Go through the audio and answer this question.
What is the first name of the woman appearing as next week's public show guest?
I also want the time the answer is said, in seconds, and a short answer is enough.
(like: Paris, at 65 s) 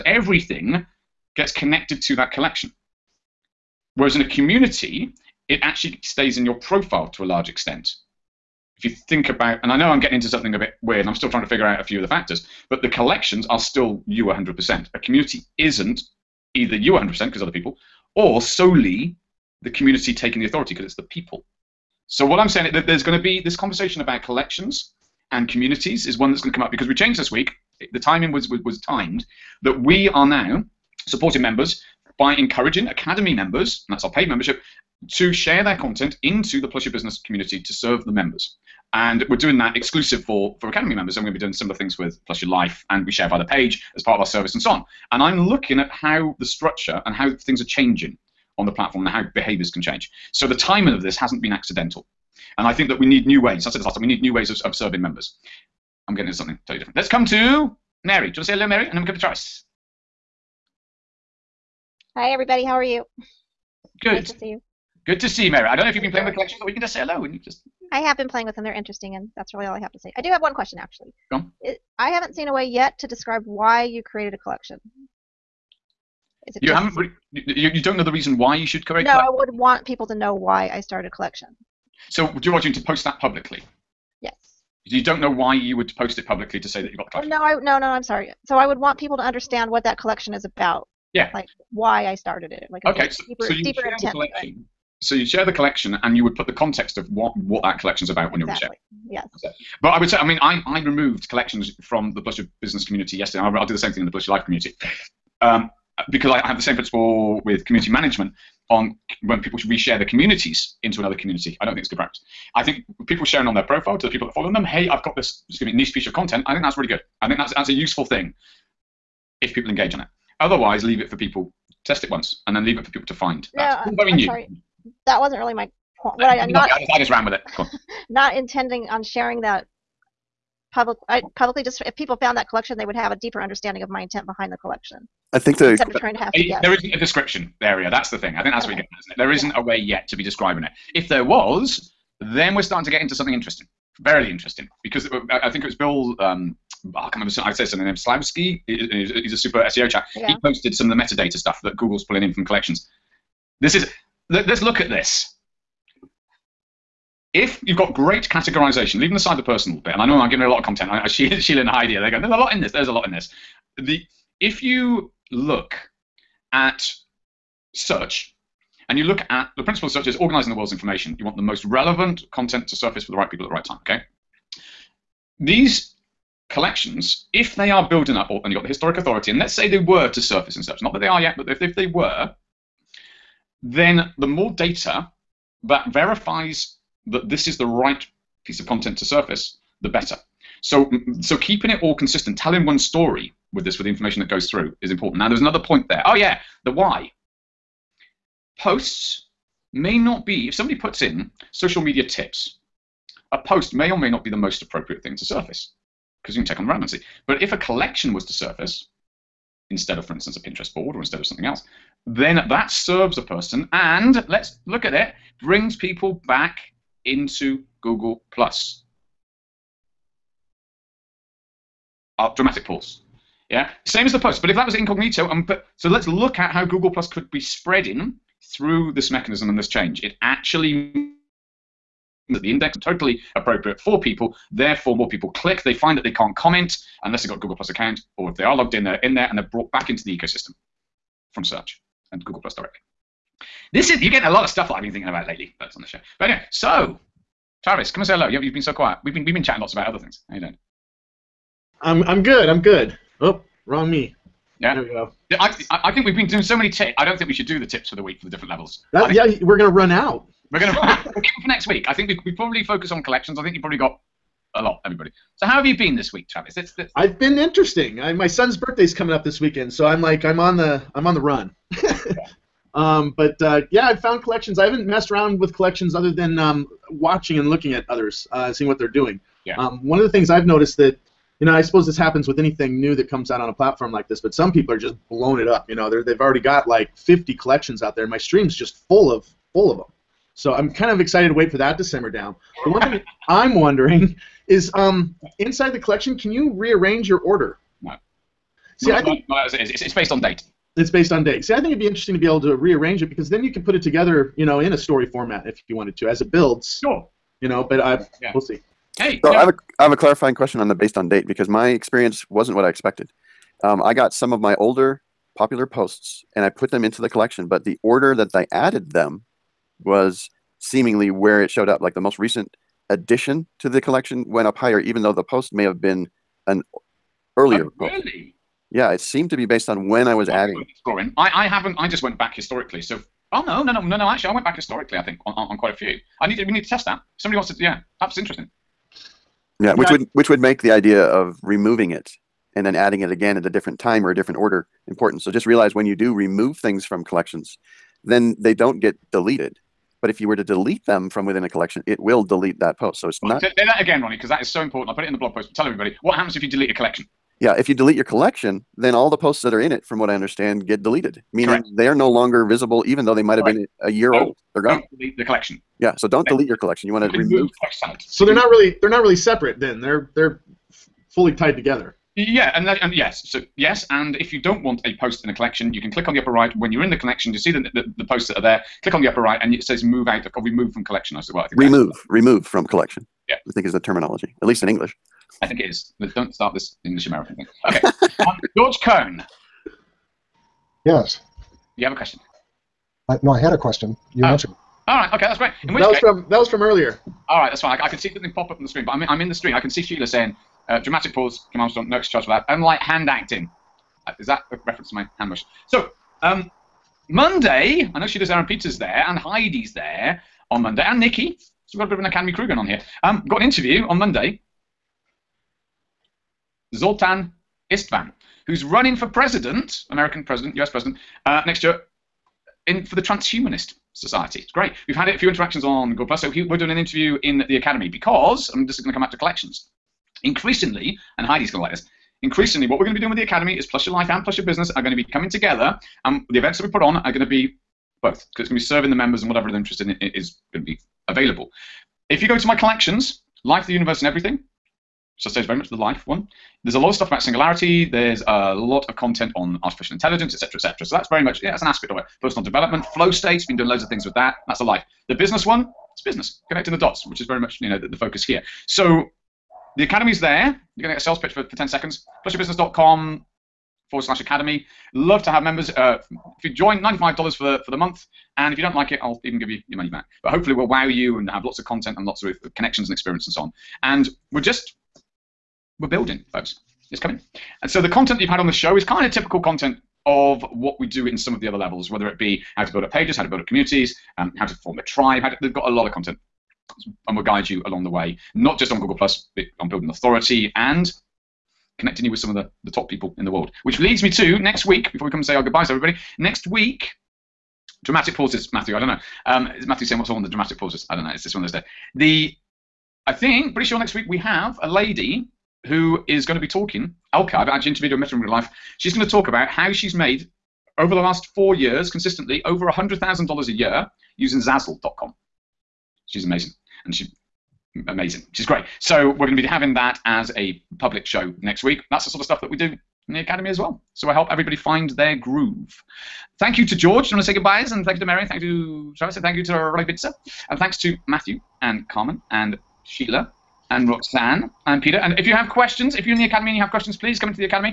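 Elka, at 507 s.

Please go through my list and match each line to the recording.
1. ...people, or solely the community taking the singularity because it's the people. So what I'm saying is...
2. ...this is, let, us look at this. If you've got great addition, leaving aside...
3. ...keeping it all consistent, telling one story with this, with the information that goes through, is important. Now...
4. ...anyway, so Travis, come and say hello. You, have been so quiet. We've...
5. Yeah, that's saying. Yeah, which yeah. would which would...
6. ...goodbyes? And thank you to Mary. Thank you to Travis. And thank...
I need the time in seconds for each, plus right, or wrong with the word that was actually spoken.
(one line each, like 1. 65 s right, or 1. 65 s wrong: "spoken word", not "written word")
1. 17 s wrong: "authority", not "singularity"
2. 153 s wrong: "categorization", not "addition"
3. 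191 s right
4. 246 s right
5. 337 s wrong: "interesting", not "saying"
6. 527 s right.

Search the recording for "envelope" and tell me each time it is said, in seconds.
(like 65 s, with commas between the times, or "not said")
not said.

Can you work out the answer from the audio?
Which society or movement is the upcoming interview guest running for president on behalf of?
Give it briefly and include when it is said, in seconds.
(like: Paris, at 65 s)
Transhumanist society, at 423 s.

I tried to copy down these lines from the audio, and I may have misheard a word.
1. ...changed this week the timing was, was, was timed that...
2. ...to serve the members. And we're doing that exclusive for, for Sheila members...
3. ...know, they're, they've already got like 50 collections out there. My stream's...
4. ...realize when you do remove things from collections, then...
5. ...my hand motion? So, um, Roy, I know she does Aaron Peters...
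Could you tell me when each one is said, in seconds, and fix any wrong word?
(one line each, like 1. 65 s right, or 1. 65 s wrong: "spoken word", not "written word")
1. 26 s right
2. 37 s wrong: "Academy", not "Sheila"
3. 285 s right
4. 345 s right
5. 404 s wrong: "Monday", not "Roy".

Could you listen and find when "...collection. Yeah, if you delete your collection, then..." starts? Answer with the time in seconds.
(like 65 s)
356 s.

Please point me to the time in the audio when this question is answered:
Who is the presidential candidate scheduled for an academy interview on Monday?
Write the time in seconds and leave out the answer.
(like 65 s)
416 s.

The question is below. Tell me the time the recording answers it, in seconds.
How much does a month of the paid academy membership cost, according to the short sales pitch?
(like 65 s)
466 s.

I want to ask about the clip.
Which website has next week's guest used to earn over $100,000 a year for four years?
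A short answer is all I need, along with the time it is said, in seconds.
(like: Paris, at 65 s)
Zazzle.com, at 514 s.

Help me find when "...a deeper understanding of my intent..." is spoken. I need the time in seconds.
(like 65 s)
133 s.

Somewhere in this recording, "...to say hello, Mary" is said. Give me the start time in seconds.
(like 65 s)
58 s.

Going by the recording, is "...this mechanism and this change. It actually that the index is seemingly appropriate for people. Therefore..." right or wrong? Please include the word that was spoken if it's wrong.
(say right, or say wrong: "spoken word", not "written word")
wrong: "totally", not "seemingly".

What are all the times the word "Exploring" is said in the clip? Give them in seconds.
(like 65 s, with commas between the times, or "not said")
330 s.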